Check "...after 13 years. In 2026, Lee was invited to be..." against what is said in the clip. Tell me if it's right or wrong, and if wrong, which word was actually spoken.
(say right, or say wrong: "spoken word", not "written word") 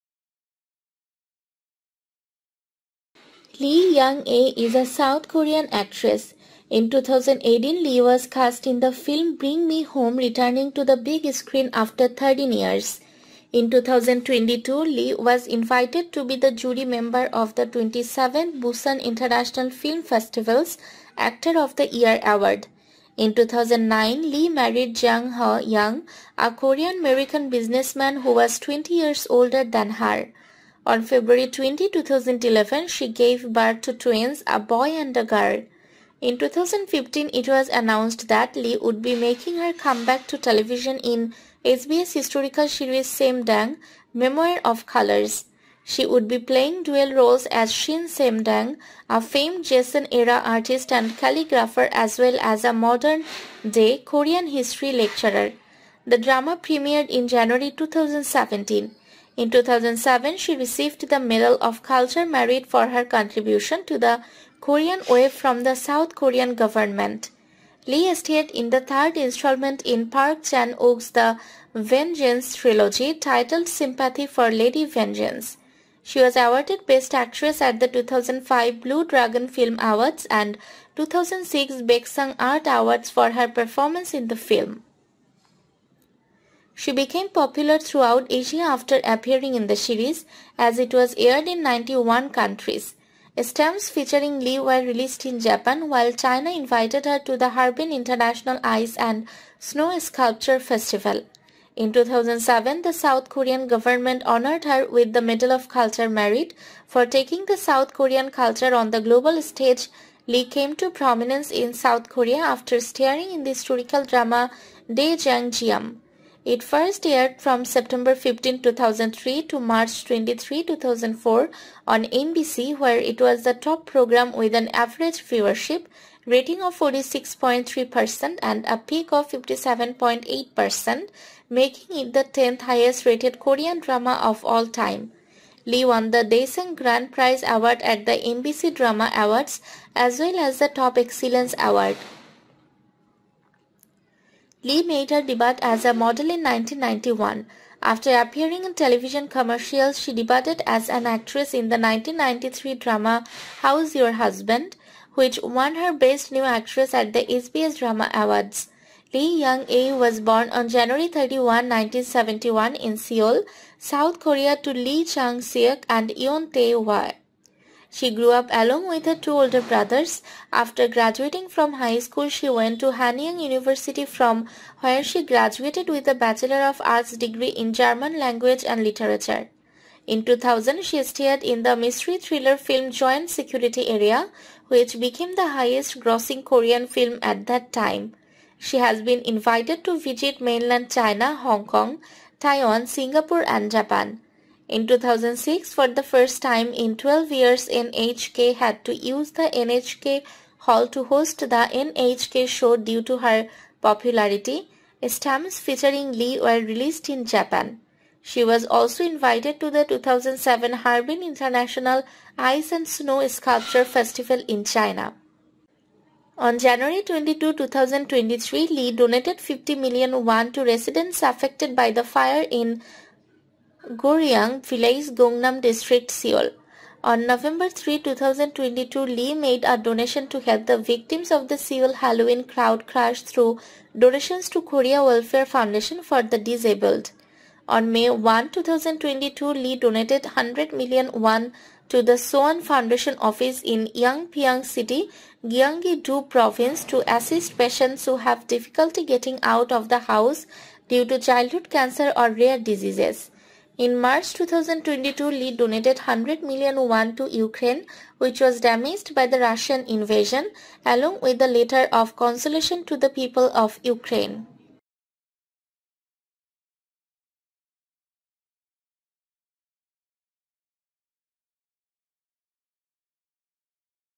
wrong: "2022", not "2026".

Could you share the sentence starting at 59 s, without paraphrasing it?
In 2007, she received the Medal of Culture Merit for her contribution to the Korean Wave from the South Korean government.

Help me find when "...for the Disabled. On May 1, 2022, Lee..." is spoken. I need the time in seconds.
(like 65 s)
236 s.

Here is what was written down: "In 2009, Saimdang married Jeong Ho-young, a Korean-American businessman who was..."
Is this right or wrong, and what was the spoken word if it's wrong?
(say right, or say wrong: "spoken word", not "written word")
wrong: "Lee", not "Saimdang".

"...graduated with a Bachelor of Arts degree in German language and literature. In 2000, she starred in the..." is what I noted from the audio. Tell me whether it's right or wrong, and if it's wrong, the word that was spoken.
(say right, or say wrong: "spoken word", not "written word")
right.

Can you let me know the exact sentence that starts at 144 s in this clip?
Lee made her debut as a model in 1991.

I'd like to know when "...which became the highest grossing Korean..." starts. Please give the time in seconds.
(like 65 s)
184 s.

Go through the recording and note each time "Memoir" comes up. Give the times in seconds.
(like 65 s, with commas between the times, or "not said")
44 s.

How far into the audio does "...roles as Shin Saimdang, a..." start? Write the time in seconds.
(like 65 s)
47 s.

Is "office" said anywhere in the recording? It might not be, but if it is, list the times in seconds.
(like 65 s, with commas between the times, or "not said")
243 s.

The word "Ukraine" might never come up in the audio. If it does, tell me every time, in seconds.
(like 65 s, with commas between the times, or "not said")
257 s, 263 s.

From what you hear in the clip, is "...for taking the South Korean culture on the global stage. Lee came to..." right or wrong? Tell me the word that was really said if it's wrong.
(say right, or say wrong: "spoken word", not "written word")
right.